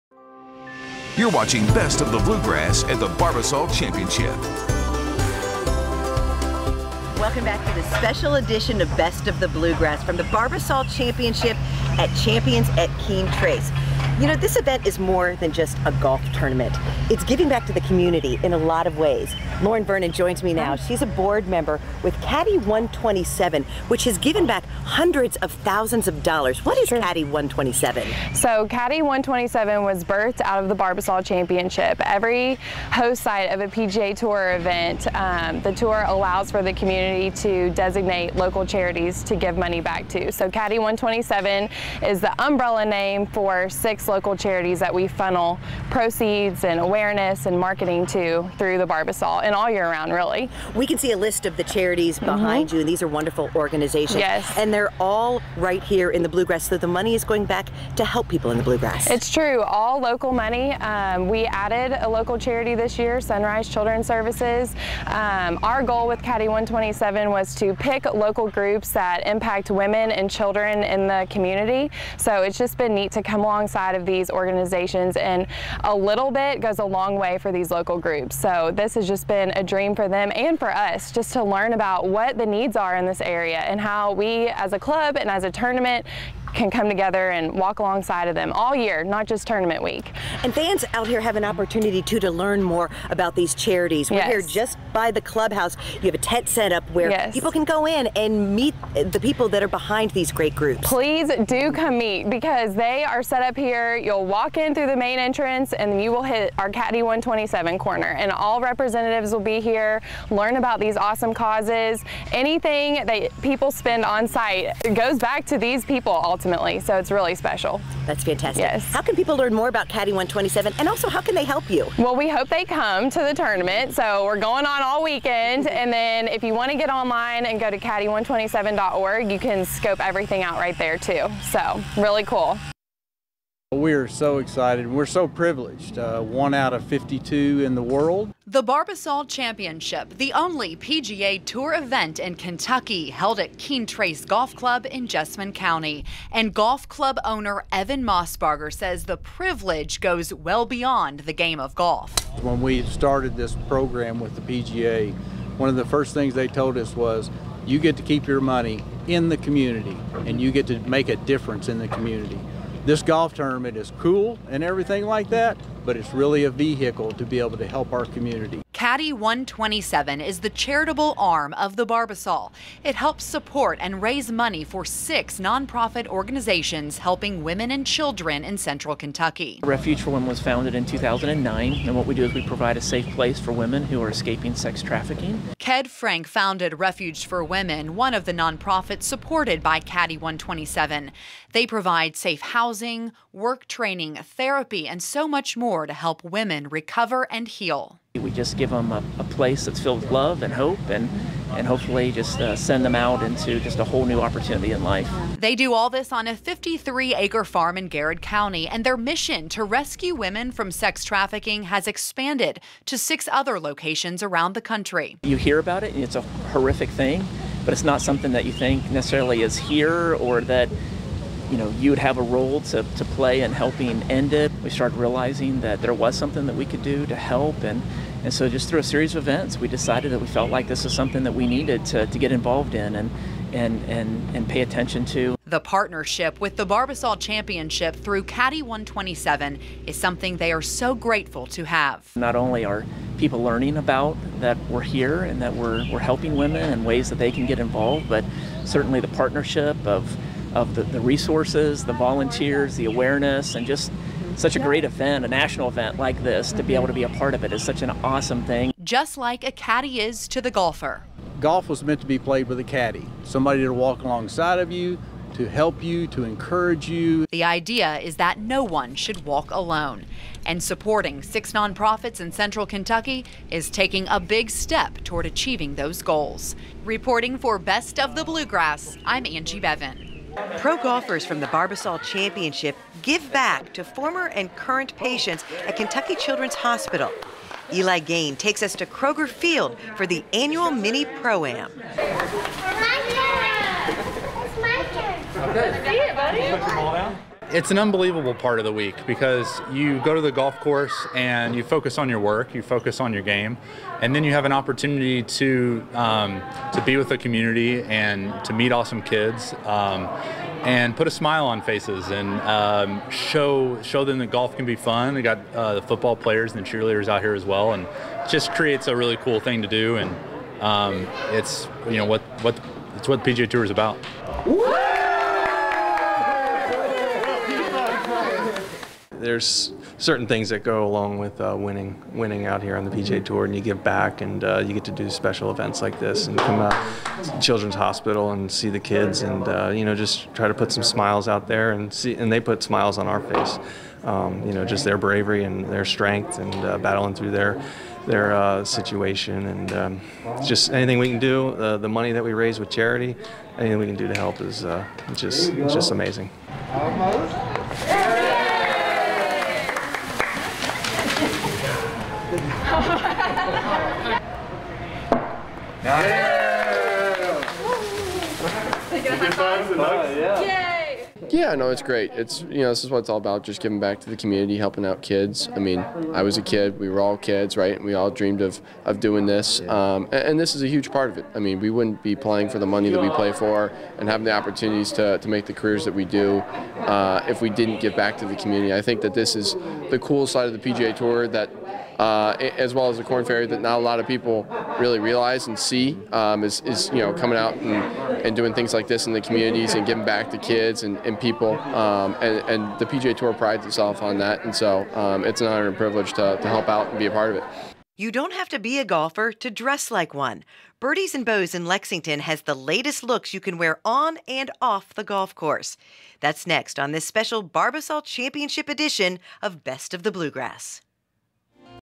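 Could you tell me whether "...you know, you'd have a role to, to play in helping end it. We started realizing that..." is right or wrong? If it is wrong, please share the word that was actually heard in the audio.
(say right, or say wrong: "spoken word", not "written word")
right.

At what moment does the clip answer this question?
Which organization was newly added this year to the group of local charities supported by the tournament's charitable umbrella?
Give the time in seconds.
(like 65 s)
63 s.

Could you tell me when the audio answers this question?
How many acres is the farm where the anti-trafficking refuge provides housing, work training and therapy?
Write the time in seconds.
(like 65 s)
206 s.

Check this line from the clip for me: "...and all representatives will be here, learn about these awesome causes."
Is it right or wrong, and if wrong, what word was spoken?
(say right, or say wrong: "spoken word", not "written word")
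right.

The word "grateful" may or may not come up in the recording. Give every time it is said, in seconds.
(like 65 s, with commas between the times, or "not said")
240 s.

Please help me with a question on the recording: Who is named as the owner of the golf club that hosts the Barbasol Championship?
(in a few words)
Evan Mossbarger.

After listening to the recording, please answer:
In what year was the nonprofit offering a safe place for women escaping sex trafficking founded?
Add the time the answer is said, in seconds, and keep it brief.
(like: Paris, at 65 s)
2009, at 180 s.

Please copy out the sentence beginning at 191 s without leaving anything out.
They provide safe housing, work training, therapy, and so much more to help women recover and heal.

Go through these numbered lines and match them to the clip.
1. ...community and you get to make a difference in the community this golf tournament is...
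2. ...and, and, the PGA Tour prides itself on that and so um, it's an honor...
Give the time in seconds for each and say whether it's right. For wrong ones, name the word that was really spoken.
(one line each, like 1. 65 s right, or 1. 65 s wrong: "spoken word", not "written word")
1. 159 s right
2. 402 s right.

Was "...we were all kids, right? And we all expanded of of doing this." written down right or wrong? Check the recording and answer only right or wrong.
wrong.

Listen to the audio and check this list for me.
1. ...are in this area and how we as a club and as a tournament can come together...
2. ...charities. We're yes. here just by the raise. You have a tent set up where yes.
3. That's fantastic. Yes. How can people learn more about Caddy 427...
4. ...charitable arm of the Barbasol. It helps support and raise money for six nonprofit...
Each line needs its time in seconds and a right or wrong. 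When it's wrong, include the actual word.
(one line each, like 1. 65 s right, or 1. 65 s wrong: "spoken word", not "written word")
1. 82 s right
2. 93 s wrong: "clubhouse", not "raise"
3. 118 s wrong: "127", not "427"
4. 170 s right.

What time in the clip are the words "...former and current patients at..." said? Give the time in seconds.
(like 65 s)
283 s.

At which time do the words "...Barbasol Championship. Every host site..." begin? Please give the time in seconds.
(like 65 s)
30 s.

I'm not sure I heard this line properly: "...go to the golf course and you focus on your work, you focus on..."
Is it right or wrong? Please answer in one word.
right.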